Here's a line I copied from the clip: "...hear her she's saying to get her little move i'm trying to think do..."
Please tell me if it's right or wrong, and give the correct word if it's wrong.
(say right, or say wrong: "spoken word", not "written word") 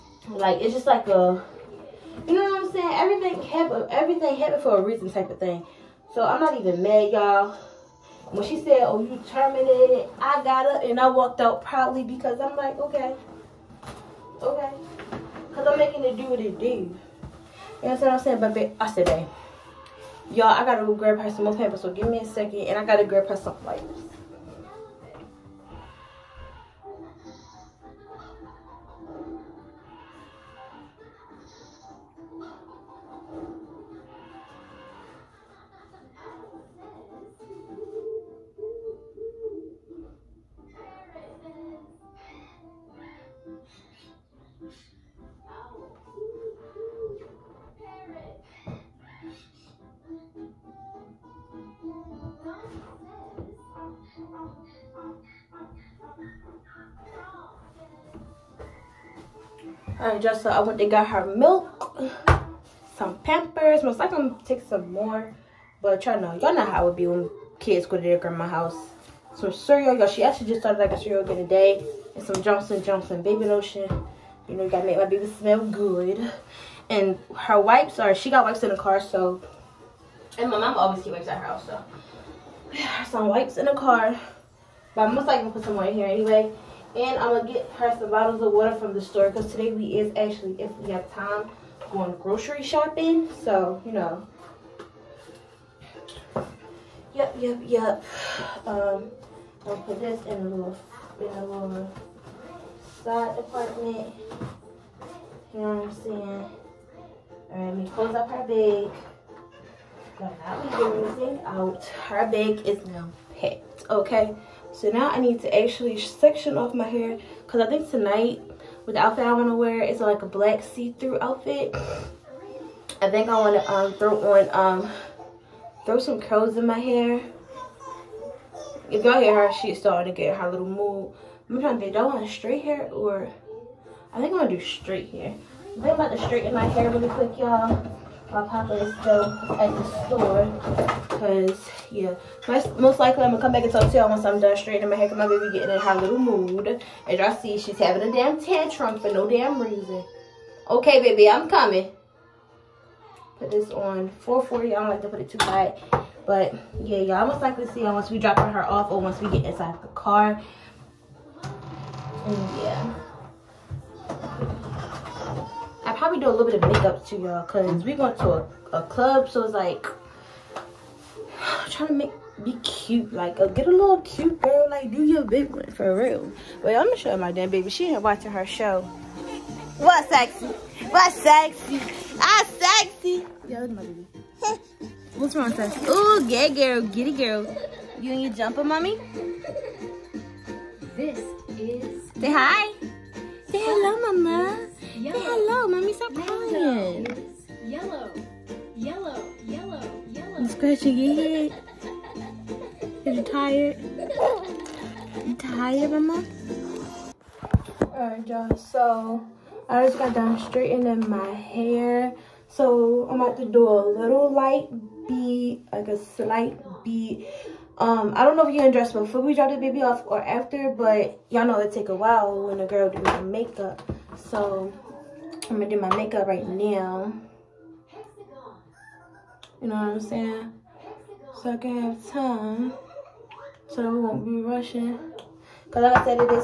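wrong: "starting", not "saying".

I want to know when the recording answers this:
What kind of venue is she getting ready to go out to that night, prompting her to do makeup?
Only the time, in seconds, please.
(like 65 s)
168 s.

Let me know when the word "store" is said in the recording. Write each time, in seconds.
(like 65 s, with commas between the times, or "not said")
89 s, 140 s.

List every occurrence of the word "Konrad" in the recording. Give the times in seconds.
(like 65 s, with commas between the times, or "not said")
not said.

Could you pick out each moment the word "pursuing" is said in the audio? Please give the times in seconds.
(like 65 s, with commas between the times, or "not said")
not said.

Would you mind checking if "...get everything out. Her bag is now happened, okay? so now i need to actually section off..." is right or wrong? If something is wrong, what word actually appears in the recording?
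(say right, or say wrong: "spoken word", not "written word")
wrong: "packed", not "happened".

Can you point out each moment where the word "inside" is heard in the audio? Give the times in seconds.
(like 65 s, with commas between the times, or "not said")
159 s.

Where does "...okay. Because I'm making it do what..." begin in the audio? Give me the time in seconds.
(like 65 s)
14 s.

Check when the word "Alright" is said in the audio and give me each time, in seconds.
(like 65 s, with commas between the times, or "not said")
107 s, 207 s.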